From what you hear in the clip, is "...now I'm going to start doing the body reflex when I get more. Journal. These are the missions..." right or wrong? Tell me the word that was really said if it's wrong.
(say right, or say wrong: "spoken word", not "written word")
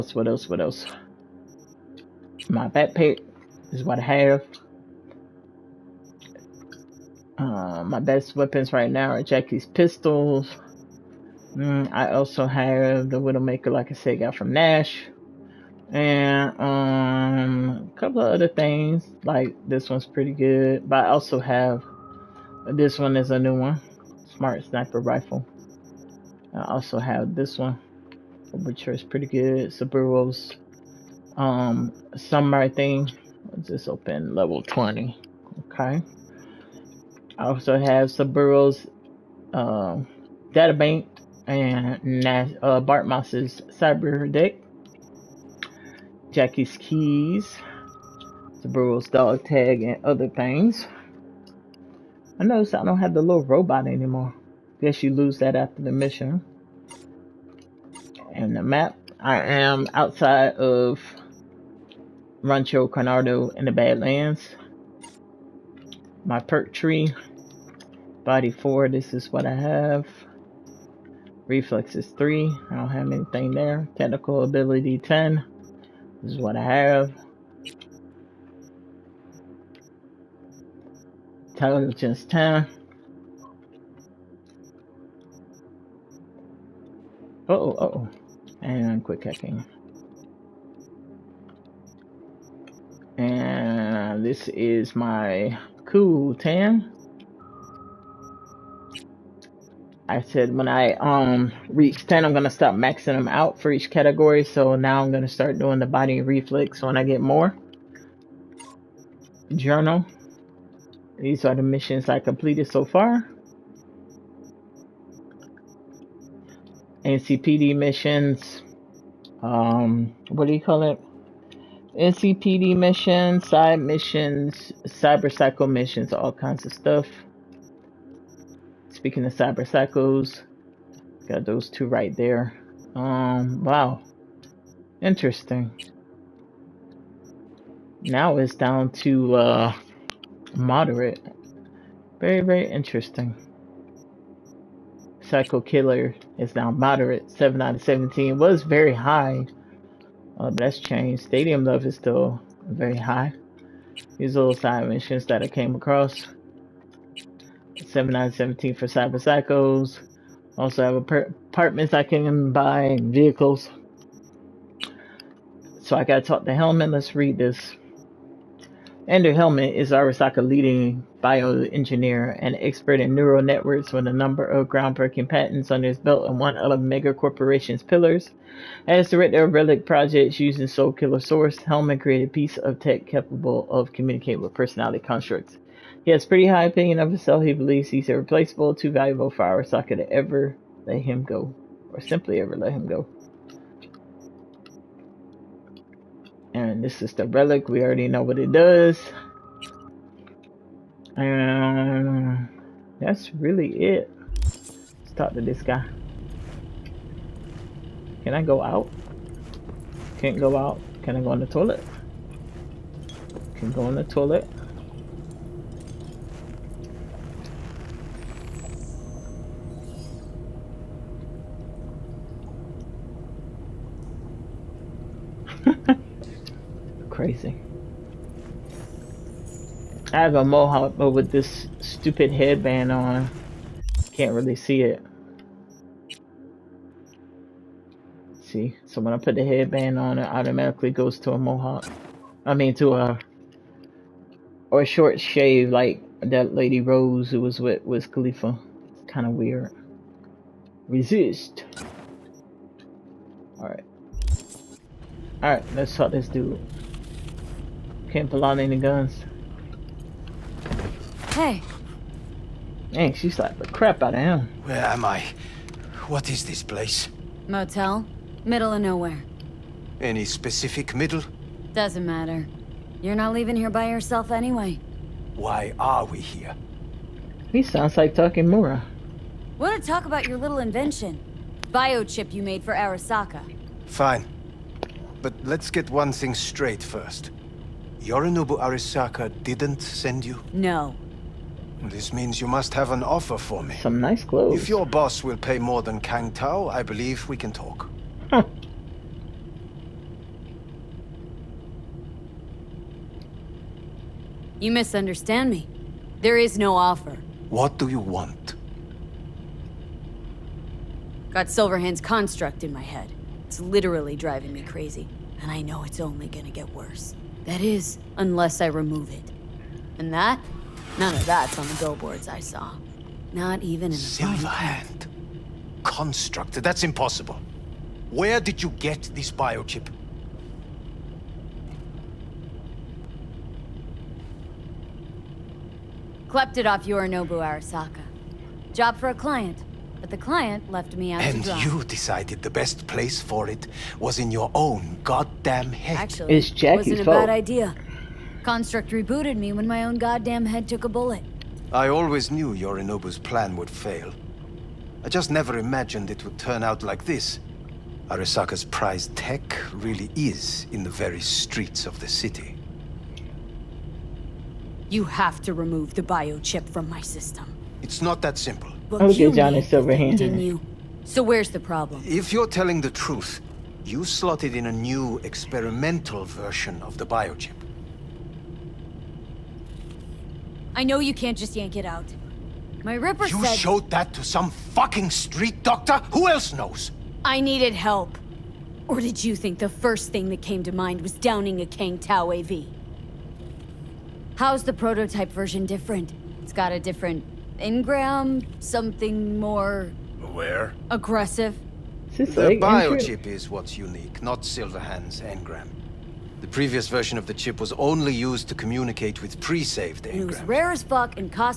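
right.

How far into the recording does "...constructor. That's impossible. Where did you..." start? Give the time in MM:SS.
05:25.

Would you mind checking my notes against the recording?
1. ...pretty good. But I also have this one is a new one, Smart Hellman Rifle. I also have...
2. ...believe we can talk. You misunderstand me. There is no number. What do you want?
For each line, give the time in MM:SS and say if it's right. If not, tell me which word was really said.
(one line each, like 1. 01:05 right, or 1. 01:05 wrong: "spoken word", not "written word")
1. 00:20 wrong: "Sniper", not "Hellman"
2. 04:56 wrong: "offer", not "number".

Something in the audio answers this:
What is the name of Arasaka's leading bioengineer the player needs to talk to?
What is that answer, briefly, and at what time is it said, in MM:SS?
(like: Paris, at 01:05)
Andrew Hellman, at 02:49.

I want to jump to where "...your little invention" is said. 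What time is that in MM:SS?
04:40.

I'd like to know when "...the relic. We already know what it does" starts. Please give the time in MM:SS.
03:17.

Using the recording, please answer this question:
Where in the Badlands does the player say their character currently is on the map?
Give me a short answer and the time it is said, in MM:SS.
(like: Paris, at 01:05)
Rancho Coronado, at 01:02.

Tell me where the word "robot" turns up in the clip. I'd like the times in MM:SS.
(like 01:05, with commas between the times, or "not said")
00:53.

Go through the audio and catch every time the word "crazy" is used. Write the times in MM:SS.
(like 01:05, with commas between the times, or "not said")
03:47, 05:14.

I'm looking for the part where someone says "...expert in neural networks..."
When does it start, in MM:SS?
02:52.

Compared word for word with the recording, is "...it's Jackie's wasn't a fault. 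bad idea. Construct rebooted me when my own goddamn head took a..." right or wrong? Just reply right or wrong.
right.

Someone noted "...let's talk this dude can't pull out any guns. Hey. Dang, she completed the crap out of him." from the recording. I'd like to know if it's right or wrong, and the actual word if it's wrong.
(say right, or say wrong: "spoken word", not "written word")
wrong: "slapped", not "completed".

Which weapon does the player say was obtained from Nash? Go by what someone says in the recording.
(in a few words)
Widowmaker.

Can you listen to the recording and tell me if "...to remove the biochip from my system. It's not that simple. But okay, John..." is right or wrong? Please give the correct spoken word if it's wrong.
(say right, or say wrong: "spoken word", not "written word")
right.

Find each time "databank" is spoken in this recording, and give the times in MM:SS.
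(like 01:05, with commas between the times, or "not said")
00:40.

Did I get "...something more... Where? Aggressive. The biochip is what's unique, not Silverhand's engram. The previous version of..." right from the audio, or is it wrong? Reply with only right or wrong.
right.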